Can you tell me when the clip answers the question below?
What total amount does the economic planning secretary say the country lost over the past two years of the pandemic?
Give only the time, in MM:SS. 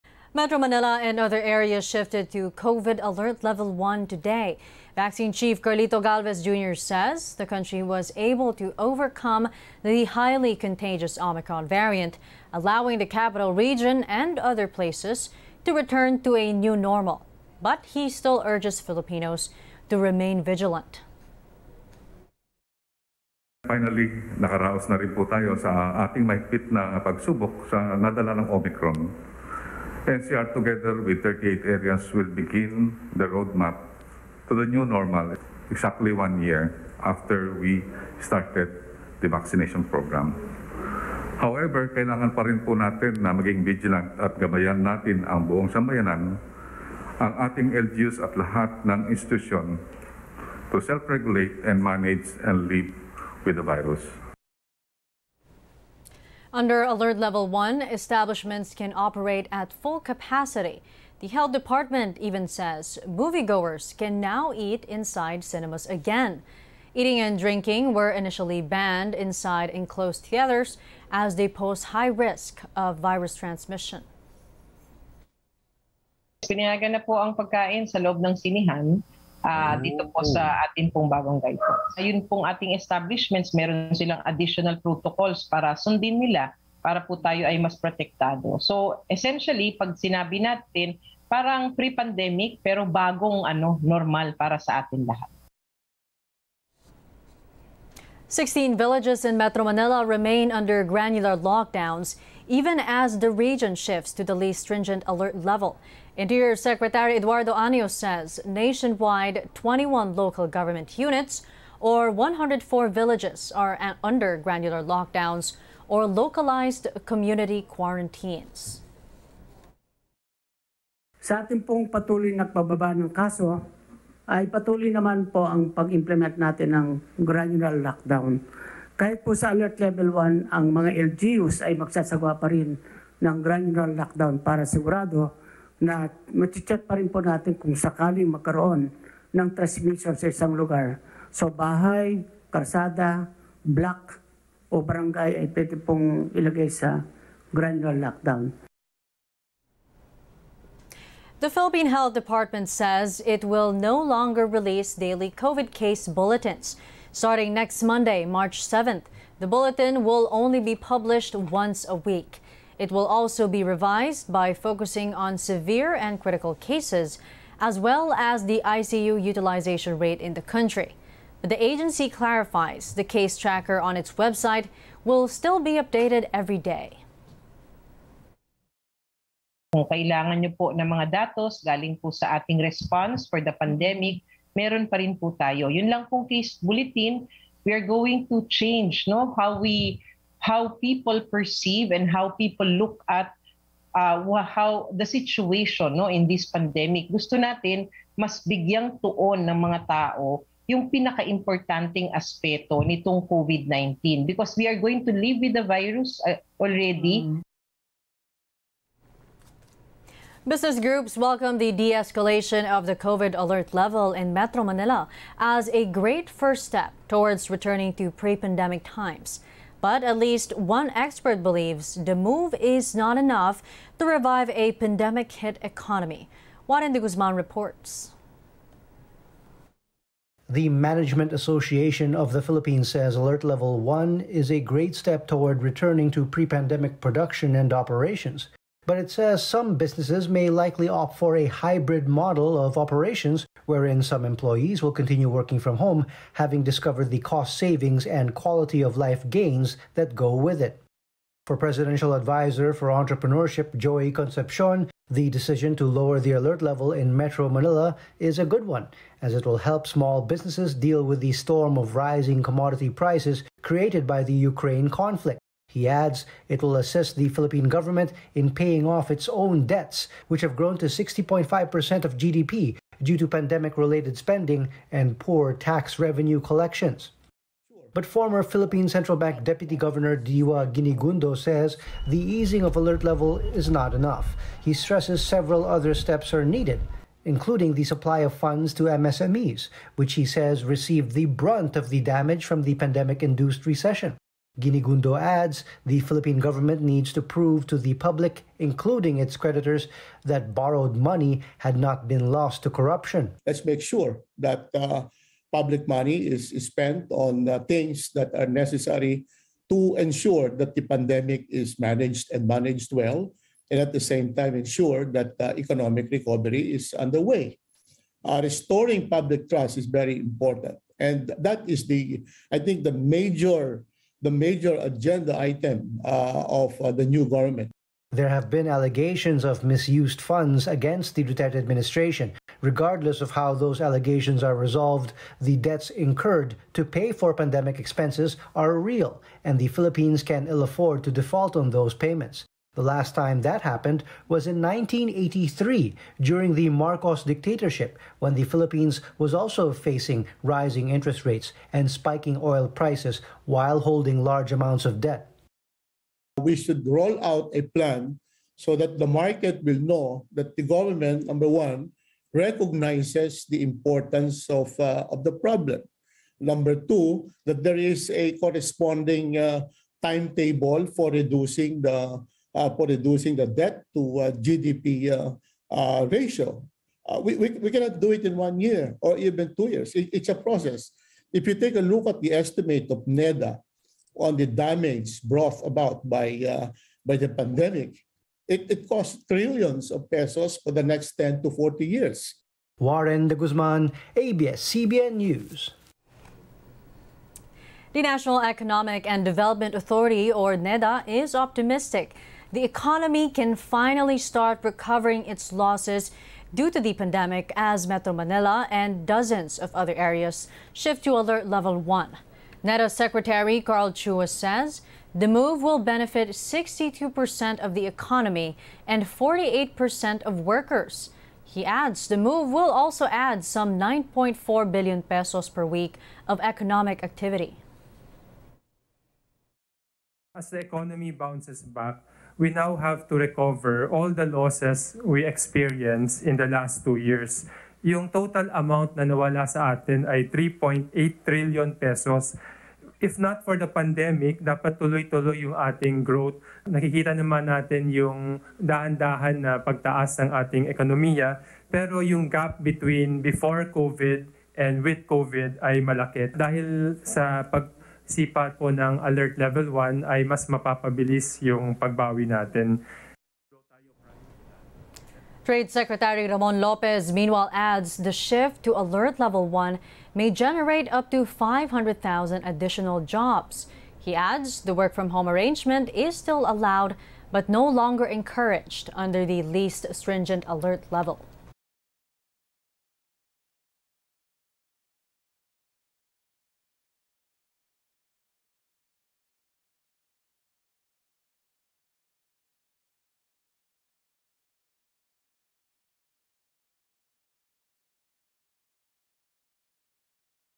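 07:20.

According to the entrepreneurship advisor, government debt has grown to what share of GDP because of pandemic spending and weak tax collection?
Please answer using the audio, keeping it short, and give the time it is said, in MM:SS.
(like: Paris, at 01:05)
60.5%, at 04:30.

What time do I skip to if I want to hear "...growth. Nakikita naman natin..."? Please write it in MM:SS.
07:26.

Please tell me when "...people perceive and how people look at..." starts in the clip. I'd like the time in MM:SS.
03:10.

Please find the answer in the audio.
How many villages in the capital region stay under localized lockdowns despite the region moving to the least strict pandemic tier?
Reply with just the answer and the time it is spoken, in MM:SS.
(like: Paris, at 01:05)
16, at 01:38.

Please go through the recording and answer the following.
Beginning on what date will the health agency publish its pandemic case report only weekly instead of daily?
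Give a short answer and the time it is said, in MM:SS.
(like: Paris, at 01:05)
March 7th, at 02:38.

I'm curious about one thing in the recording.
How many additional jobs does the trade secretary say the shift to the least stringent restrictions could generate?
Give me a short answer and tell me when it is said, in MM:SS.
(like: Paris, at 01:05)
500,000, at 07:51.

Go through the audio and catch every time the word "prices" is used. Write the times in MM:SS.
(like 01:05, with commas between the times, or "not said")
04:22, 05:52.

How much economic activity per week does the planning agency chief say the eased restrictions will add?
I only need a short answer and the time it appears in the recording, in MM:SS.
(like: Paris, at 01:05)
9.4 billion pesos, at 07:03.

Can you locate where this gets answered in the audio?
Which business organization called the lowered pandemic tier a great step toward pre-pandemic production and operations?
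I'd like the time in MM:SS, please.
03:50.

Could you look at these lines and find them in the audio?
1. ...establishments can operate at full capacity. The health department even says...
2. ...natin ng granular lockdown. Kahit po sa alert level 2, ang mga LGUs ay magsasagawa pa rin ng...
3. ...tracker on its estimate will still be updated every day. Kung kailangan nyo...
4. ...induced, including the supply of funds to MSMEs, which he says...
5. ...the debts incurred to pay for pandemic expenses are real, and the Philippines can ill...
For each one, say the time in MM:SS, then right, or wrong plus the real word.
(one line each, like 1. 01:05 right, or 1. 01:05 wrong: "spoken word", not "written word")
1. 00:57 right
2. 02:06 wrong: "1", not "2"
3. 02:53 wrong: "website", not "estimate"
4. 04:46 wrong: "needed", not "induced"
5. 05:35 right.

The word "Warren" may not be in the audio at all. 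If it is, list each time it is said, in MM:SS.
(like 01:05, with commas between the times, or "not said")
03:46, 06:32.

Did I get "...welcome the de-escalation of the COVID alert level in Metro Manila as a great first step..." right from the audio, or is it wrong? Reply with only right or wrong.
right.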